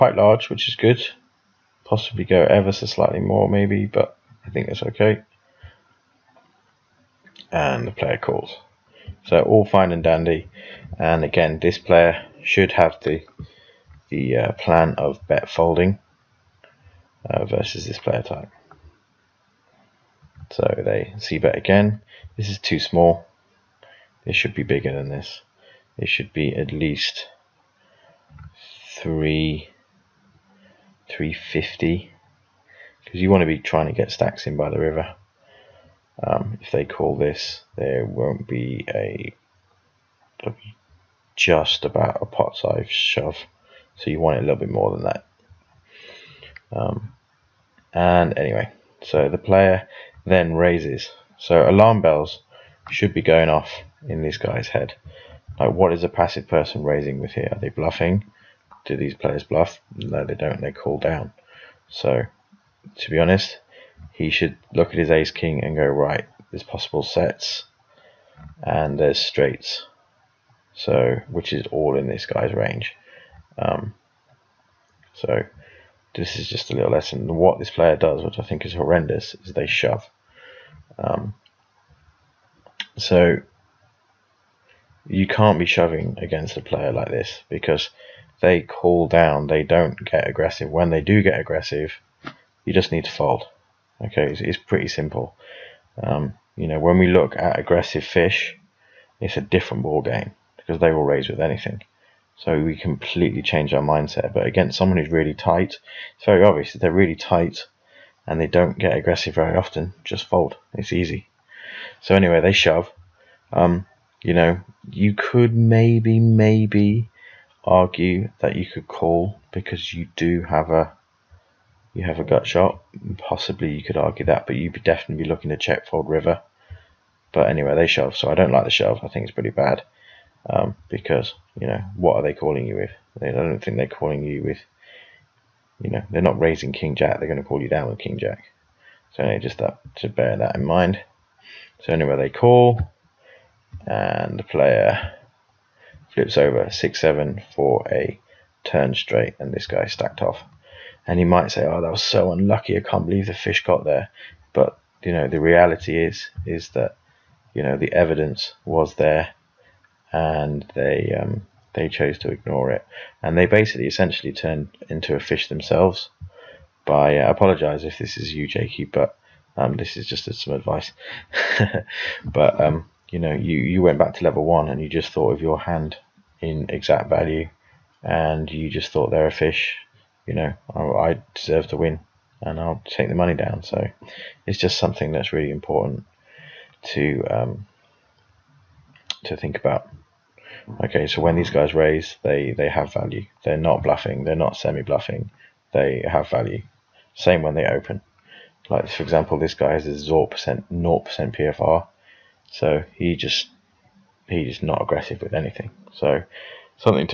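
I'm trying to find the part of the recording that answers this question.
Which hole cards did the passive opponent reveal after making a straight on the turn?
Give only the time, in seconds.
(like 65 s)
146 s.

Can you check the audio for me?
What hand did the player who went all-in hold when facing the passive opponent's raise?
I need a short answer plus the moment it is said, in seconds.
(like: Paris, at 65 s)
Ace king, at 65 s.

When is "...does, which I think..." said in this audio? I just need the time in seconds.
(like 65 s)
77 s.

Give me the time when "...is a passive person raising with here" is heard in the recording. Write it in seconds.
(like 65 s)
55 s.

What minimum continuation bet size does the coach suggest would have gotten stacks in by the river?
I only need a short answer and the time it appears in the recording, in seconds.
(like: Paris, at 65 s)
350, at 31 s.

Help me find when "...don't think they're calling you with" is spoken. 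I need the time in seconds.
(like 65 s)
133 s.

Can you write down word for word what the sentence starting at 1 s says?
Possibly go ever so slightly more, maybe, but I think that's okay.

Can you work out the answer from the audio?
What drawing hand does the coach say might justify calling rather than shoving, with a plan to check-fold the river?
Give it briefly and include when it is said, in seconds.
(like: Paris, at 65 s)
Gut shot, at 122 s.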